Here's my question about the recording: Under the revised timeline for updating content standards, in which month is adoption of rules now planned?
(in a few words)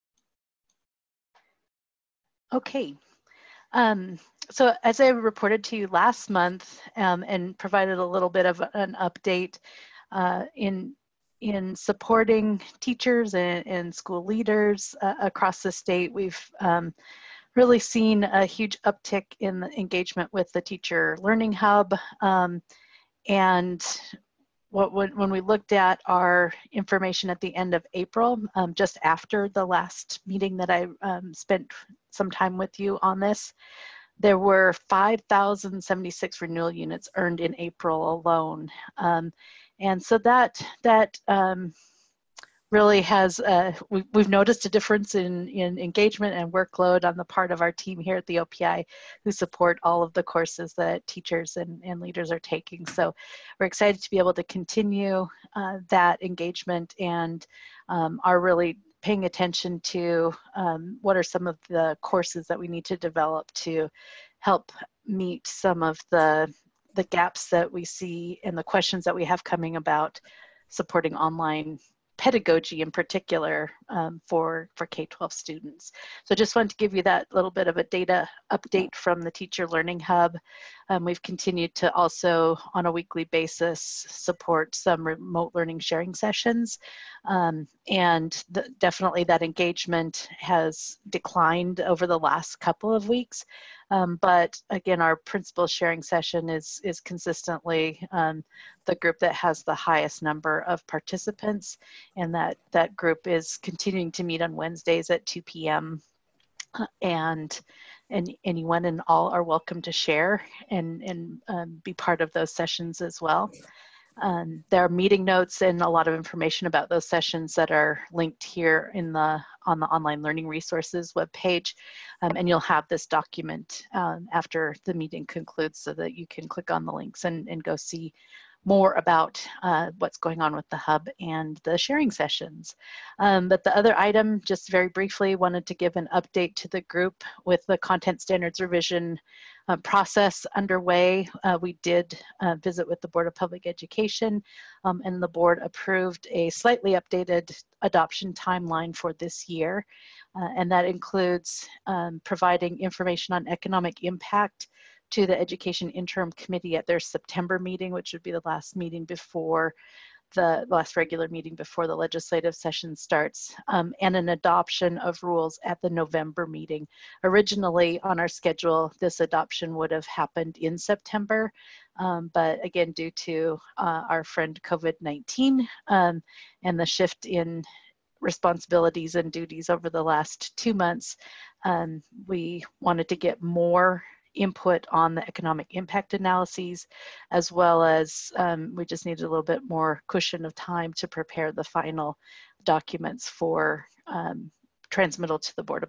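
November.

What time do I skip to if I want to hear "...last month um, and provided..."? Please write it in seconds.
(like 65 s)
5 s.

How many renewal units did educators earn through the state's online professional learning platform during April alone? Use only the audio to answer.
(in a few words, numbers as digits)
5,076.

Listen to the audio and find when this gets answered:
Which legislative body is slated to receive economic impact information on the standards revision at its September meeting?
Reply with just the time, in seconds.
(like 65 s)
155 s.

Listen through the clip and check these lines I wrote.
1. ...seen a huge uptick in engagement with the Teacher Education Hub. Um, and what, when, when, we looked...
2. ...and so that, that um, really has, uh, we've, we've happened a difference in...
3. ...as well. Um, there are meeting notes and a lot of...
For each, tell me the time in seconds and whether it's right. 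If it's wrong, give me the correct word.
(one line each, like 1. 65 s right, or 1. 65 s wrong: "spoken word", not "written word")
1. 17 s wrong: "Learning", not "Education"
2. 39 s wrong: "noticed", not "happened"
3. 113 s right.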